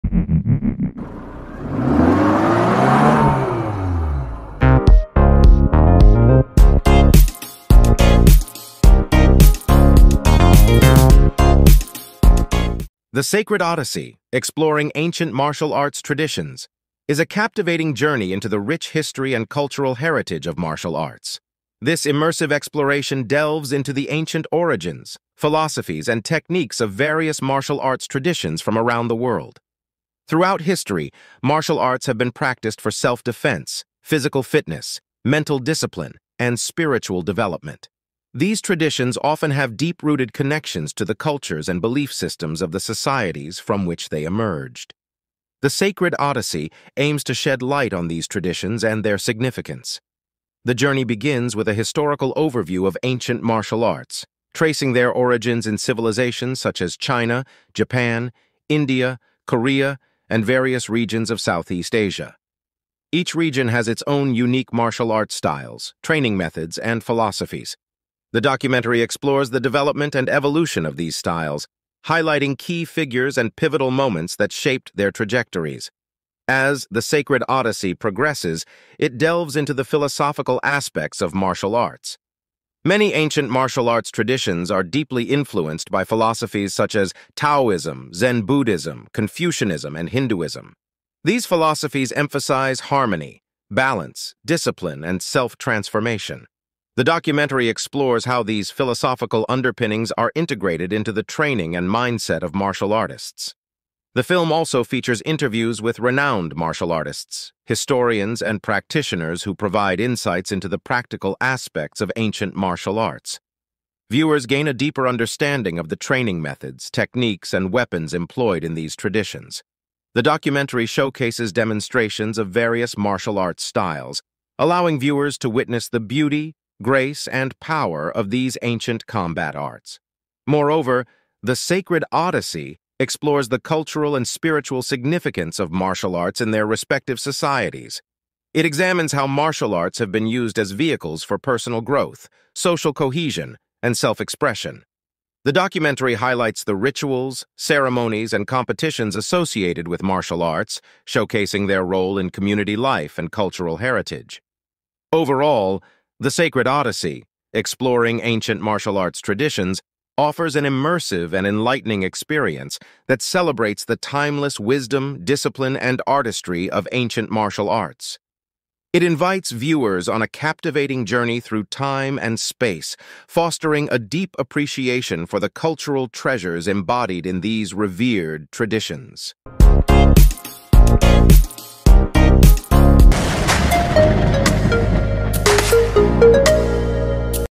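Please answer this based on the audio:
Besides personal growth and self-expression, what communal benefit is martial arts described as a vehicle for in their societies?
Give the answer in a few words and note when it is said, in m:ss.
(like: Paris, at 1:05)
Social cohesion, at 2:22.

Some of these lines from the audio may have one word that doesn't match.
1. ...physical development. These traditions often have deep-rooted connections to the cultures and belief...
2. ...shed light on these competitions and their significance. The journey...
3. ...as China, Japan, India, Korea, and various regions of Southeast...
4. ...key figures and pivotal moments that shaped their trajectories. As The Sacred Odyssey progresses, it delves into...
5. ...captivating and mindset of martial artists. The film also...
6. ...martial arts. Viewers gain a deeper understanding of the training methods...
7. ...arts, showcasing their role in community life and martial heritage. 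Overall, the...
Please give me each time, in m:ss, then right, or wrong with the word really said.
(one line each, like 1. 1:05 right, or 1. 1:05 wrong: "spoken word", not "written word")
1. 0:36 wrong: "spiritual", not "physical"
2. 0:47 wrong: "traditions", not "competitions"
3. 0:56 right
4. 1:12 right
5. 1:41 wrong: "training", not "captivating"
6. 1:52 right
7. 2:30 wrong: "cultural", not "martial".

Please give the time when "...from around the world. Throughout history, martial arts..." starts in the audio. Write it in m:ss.
0:28.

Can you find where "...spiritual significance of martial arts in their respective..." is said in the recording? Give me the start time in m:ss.
2:14.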